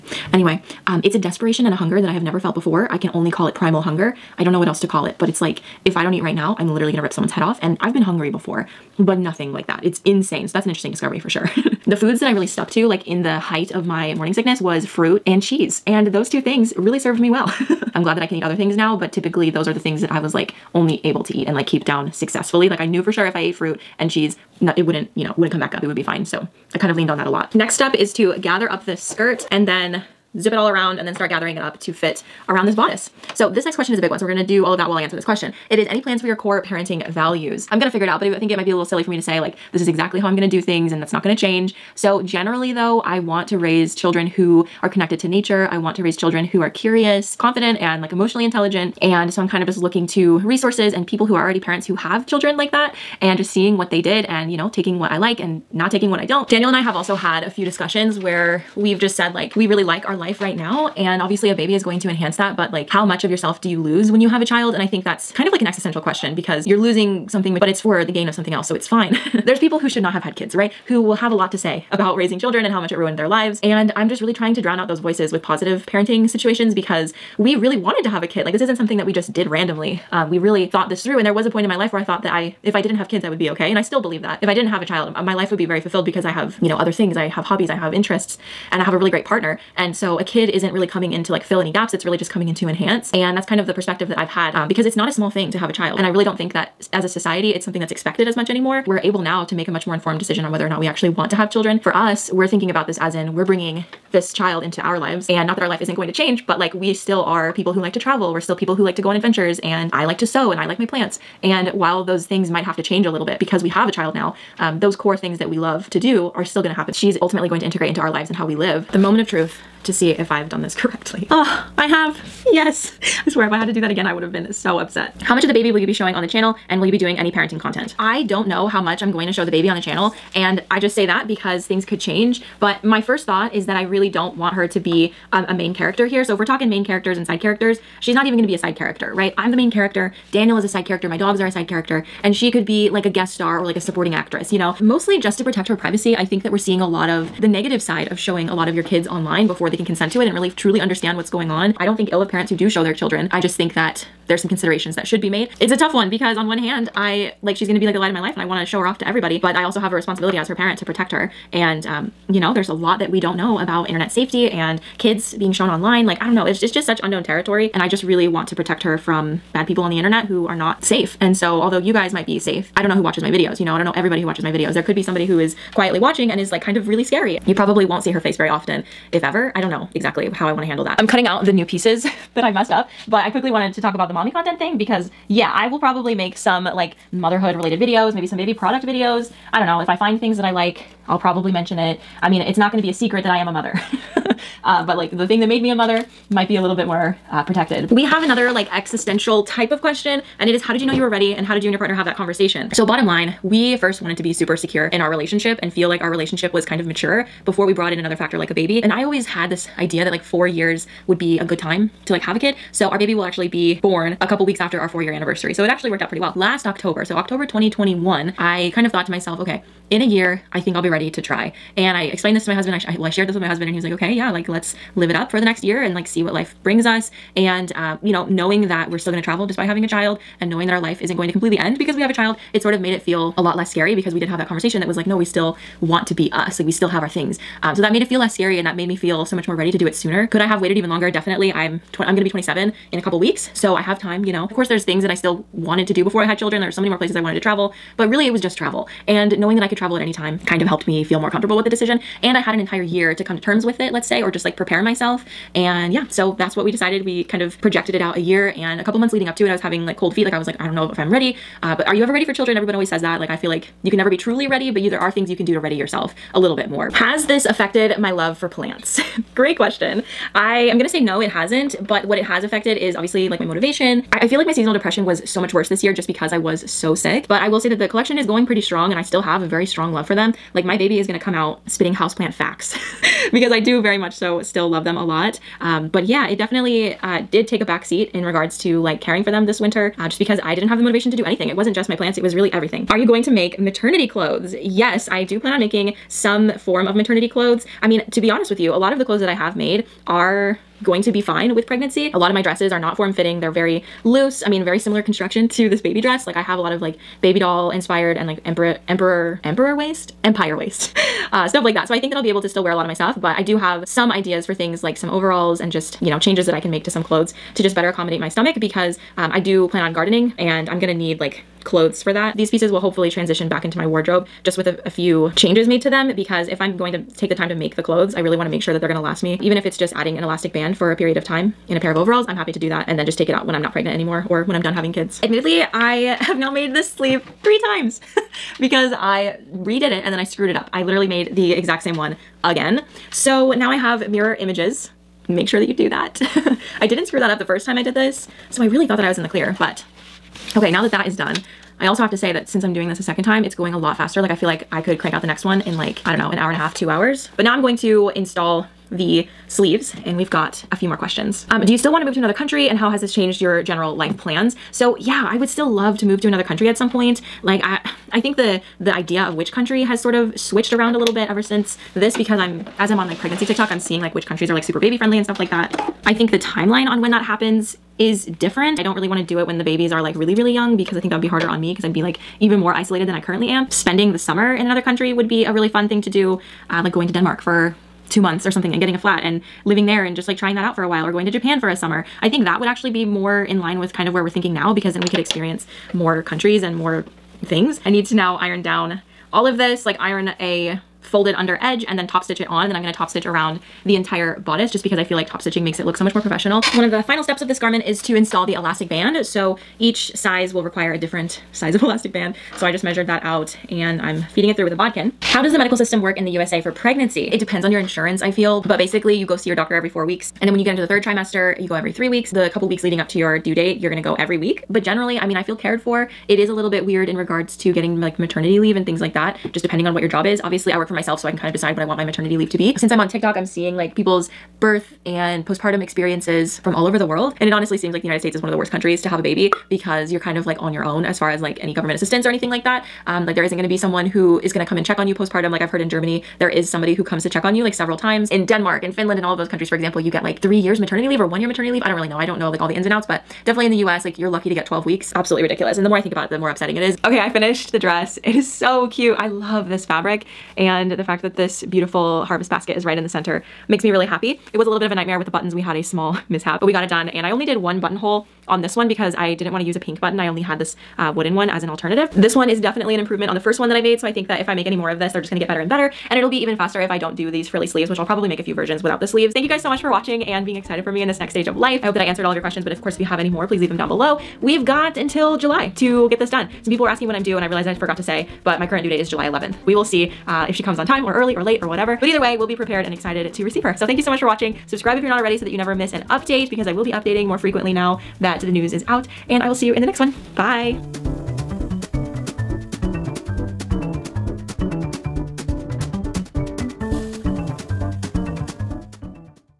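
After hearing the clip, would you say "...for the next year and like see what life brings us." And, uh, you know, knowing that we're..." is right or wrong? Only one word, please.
right.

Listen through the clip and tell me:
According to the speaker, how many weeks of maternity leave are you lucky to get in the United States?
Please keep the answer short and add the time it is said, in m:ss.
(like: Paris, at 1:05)
12, at 7:34.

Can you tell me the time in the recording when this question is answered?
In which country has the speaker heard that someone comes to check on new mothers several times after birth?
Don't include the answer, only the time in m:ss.
7:25.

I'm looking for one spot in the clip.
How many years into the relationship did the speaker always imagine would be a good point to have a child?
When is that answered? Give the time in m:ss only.
3:30.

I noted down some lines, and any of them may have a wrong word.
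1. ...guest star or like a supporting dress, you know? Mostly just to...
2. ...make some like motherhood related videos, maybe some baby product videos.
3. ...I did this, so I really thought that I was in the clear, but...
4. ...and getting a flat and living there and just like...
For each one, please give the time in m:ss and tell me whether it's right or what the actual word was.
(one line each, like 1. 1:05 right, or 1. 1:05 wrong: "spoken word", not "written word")
1. 2:23 wrong: "actress", not "dress"
2. 3:06 right
3. 5:47 right
4. 6:28 right.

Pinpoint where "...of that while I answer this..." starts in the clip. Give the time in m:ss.
0:34.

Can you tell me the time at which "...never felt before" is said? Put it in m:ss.
0:02.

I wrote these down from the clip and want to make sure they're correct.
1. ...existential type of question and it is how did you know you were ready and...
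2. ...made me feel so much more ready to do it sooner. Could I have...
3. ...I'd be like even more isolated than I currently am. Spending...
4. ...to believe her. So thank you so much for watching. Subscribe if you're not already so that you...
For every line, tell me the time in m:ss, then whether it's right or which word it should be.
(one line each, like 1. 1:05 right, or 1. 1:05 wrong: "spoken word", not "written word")
1. 3:18 right
2. 3:58 right
3. 6:21 right
4. 8:13 wrong: "receive", not "believe".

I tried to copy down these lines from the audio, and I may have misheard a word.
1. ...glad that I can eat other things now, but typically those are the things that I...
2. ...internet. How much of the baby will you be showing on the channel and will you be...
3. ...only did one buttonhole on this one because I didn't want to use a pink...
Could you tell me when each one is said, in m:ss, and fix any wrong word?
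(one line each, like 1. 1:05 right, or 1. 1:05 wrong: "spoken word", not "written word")
1. 0:18 right
2. 2:04 wrong: "upset", not "internet"
3. 7:47 right.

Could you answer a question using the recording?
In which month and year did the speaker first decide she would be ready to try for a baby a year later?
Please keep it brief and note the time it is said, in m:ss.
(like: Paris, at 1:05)
October 2021, at 3:37.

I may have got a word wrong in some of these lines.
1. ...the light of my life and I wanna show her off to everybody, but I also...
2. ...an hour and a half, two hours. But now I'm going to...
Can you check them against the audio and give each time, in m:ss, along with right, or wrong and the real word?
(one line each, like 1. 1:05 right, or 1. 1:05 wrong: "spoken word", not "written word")
1. 2:37 right
2. 5:56 right.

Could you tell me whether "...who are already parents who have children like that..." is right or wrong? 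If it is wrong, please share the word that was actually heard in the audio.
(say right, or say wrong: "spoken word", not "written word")
right.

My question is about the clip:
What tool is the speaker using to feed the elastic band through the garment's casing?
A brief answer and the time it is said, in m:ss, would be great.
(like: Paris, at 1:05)
Bodkin, at 6:54.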